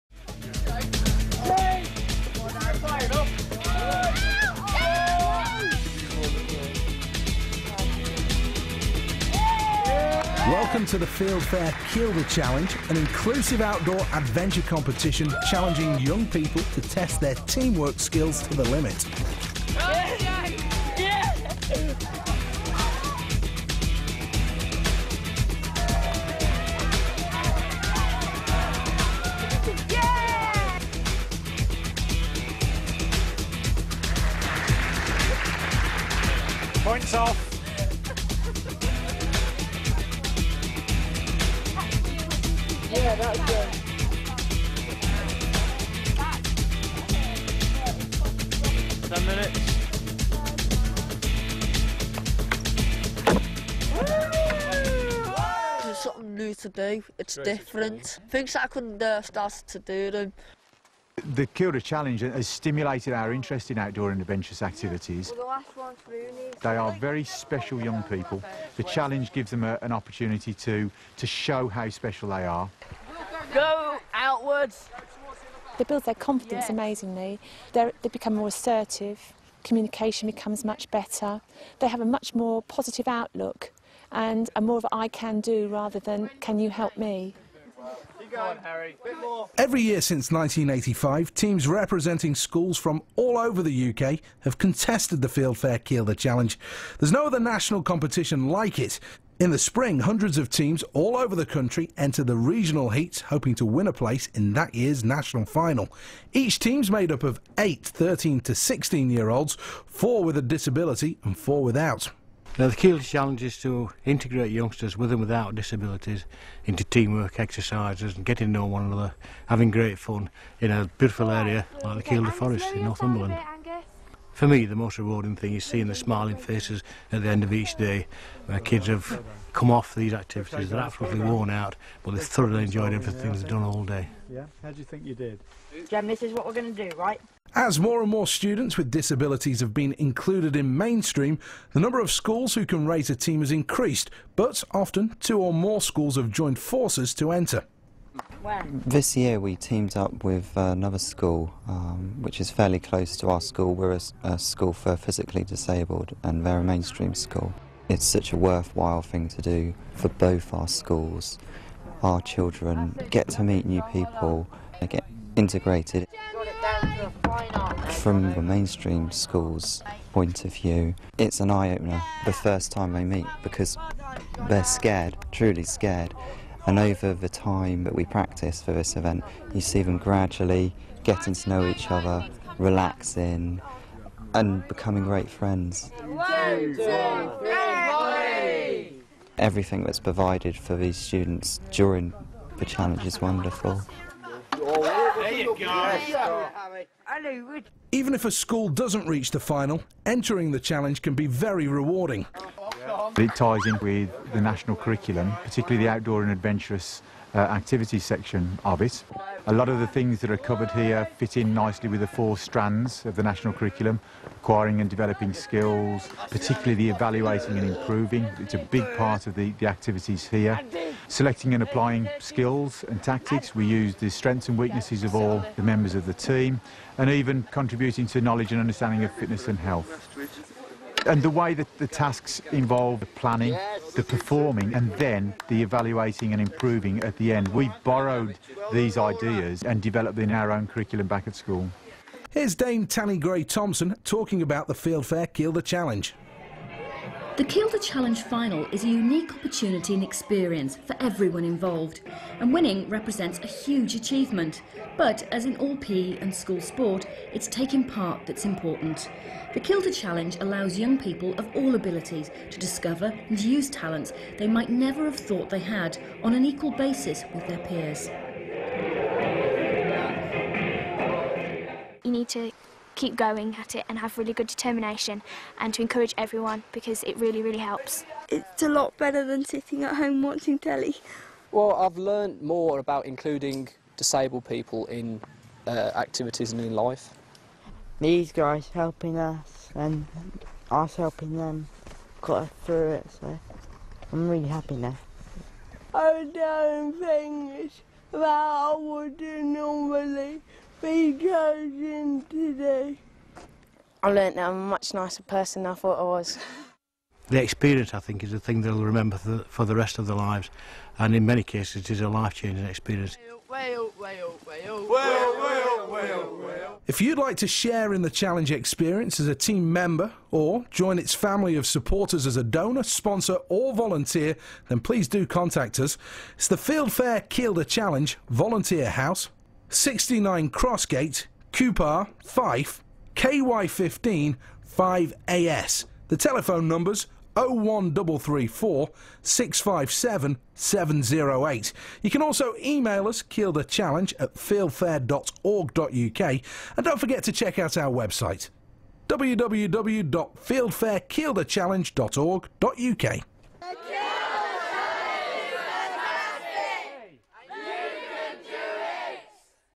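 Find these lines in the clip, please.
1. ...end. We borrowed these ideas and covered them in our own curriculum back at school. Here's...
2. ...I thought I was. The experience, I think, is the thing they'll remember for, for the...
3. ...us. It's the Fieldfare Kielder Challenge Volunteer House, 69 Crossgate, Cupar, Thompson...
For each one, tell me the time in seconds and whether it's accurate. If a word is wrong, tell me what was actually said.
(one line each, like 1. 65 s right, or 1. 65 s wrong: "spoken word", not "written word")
1. 237 s wrong: "developed", not "covered"
2. 305 s right
3. 325 s wrong: "Fife", not "Thompson".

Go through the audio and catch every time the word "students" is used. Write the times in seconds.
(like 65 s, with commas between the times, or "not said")
138 s, 190 s.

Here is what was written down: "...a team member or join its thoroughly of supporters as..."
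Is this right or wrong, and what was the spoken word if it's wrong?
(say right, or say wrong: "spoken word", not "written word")
wrong: "family", not "thoroughly".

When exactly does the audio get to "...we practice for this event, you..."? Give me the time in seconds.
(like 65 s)
177 s.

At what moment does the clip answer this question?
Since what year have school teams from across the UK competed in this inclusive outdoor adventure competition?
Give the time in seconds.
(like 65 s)
90 s.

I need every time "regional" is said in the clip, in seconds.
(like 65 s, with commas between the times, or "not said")
102 s.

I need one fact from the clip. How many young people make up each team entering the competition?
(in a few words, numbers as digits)
8.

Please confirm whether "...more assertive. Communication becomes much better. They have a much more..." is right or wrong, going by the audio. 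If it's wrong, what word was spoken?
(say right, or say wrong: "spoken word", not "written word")
right.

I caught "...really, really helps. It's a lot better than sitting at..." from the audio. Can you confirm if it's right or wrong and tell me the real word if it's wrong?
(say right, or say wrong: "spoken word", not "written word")
right.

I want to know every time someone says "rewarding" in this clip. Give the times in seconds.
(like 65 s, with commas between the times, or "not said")
124 s, 201 s.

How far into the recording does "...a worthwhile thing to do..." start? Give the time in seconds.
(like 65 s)
158 s.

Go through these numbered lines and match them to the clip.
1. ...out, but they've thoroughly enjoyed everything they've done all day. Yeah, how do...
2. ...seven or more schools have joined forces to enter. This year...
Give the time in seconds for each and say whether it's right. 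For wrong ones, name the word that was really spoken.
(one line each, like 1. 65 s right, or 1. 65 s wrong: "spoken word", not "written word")
1. 131 s right
2. 145 s wrong: "two", not "seven".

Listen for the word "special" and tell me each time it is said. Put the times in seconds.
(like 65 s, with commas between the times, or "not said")
67 s, 71 s.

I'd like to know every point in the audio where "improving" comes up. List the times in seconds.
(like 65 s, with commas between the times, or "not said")
217 s, 236 s.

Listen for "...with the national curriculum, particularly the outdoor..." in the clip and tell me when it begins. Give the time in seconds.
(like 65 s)
203 s.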